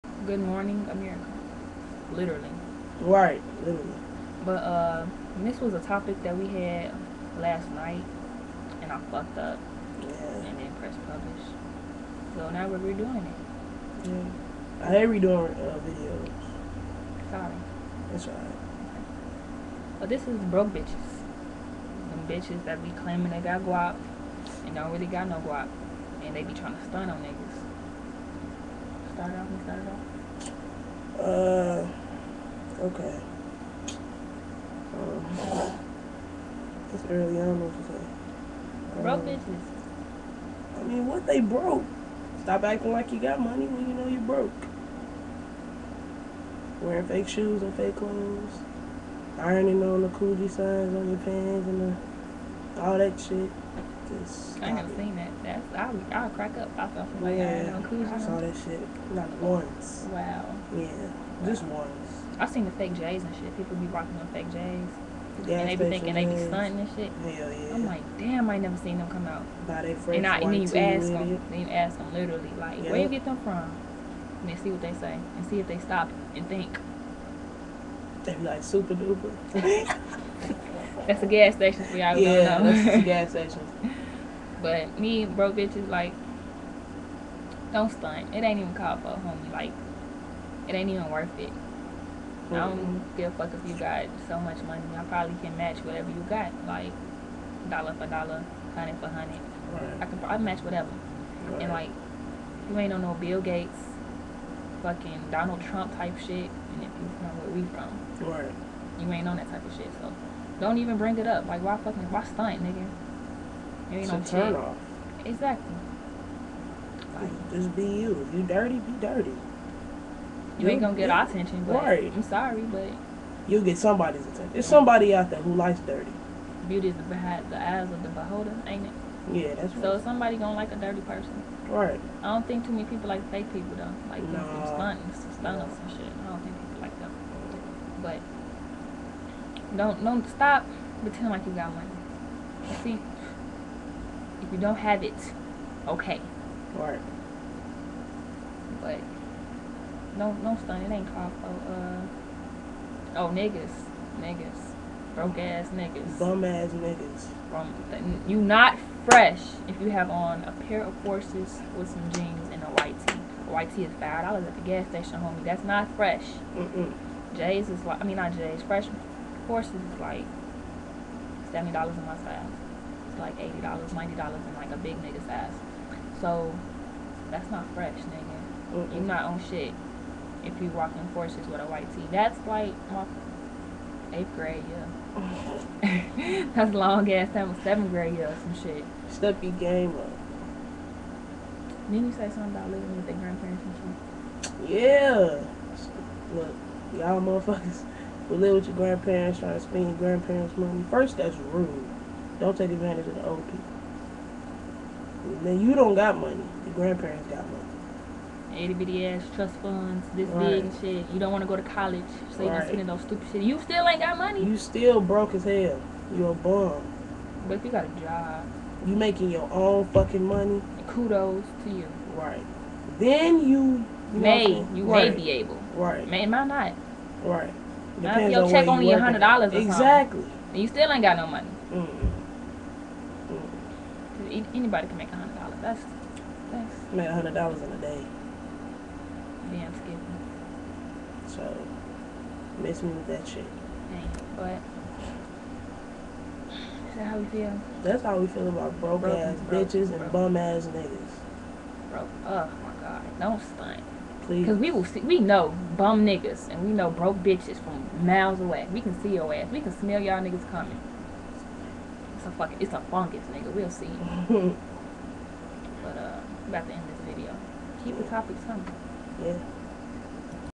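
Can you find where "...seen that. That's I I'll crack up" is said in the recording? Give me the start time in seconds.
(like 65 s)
54 s.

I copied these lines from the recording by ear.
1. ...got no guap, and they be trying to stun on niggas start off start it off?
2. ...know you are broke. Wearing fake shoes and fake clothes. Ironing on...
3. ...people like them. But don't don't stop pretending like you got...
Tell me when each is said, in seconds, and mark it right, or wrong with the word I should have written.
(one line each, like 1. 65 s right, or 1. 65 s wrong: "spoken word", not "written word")
1. 25 s right
2. 43 s right
3. 136 s right.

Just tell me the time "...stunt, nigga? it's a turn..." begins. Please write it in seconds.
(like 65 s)
112 s.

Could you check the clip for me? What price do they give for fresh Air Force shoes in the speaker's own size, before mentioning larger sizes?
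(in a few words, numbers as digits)
$70.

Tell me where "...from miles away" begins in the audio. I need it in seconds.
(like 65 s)
257 s.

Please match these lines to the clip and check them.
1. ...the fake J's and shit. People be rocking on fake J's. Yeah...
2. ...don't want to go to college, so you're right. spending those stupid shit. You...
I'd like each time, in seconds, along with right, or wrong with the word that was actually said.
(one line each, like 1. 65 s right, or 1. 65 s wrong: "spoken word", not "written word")
1. 62 s right
2. 211 s right.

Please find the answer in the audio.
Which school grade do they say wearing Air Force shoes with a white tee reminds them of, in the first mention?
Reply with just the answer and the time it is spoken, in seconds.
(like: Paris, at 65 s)
Eighth grade, at 184 s.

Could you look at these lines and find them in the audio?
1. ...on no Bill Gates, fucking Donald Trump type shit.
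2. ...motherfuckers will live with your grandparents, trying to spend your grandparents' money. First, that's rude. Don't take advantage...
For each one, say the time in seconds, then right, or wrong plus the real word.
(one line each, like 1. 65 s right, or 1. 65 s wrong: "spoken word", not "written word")
1. 102 s right
2. 197 s right.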